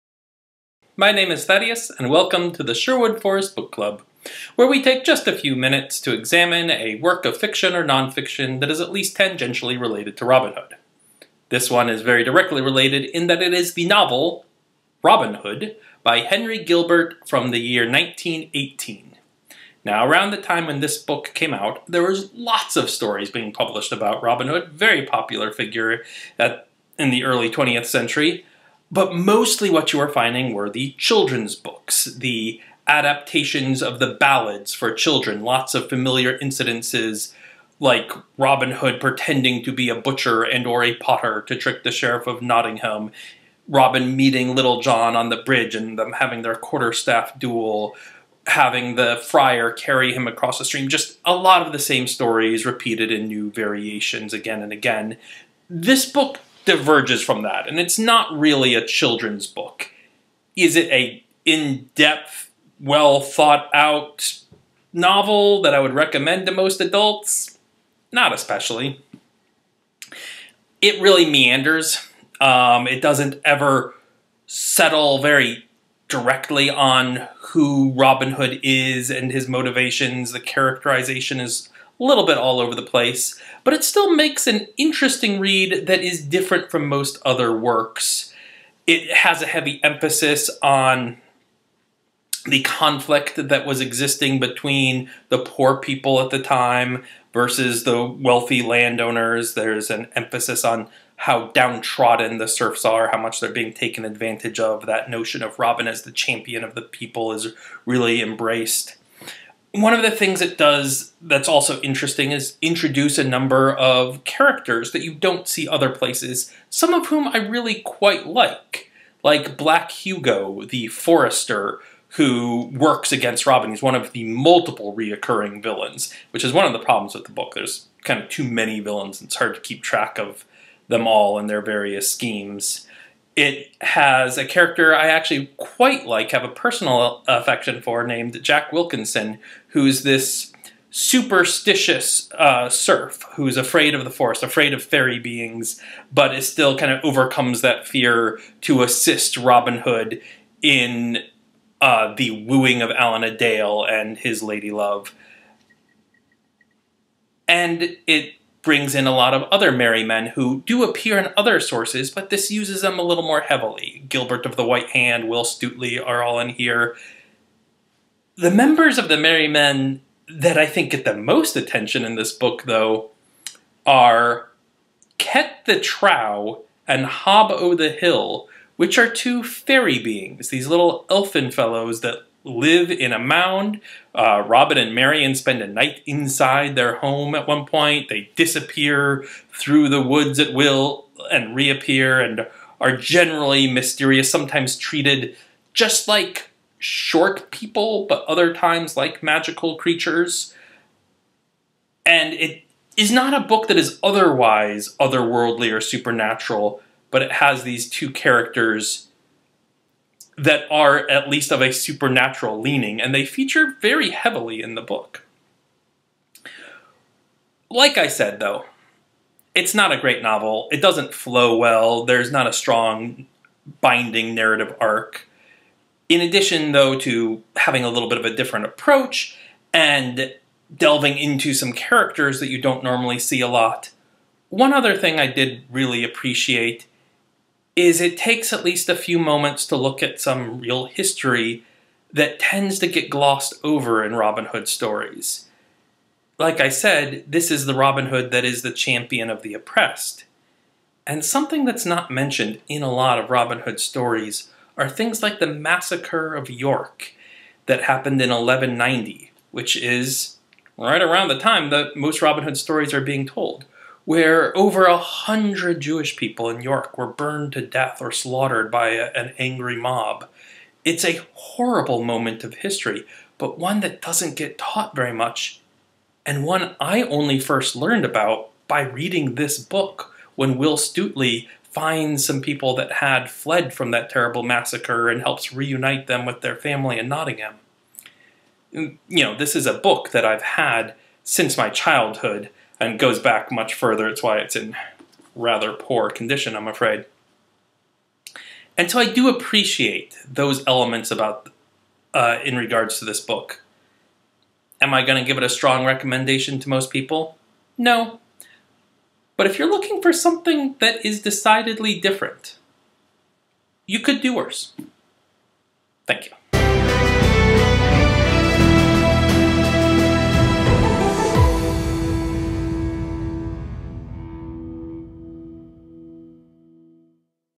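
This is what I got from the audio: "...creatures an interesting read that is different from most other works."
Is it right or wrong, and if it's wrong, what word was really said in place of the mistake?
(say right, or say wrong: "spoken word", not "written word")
wrong: "makes", not "creatures".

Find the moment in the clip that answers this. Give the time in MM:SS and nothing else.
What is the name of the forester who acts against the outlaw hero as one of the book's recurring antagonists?
01:59.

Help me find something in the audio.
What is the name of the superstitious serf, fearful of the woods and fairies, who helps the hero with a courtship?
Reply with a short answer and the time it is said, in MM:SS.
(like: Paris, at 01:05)
Jack Wilkinson, at 02:18.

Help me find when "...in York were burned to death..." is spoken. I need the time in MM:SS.
04:26.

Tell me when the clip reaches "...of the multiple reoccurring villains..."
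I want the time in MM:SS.
02:03.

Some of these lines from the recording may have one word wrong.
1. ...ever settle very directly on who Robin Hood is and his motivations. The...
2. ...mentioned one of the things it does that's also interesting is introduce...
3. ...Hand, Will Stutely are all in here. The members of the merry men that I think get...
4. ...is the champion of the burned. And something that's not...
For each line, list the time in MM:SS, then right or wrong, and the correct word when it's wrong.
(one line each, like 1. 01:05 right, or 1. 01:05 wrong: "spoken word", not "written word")
1. 01:13 right
2. 01:48 wrong: "embraced", not "mentioned"
3. 02:44 right
4. 04:08 wrong: "oppressed", not "burned".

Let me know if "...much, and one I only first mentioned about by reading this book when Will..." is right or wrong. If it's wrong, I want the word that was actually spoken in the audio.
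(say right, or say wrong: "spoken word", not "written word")
wrong: "learned", not "mentioned".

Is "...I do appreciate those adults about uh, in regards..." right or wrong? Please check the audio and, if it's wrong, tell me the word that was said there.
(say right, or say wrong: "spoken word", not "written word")
wrong: "elements", not "adults".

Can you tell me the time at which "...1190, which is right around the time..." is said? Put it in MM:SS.
04:18.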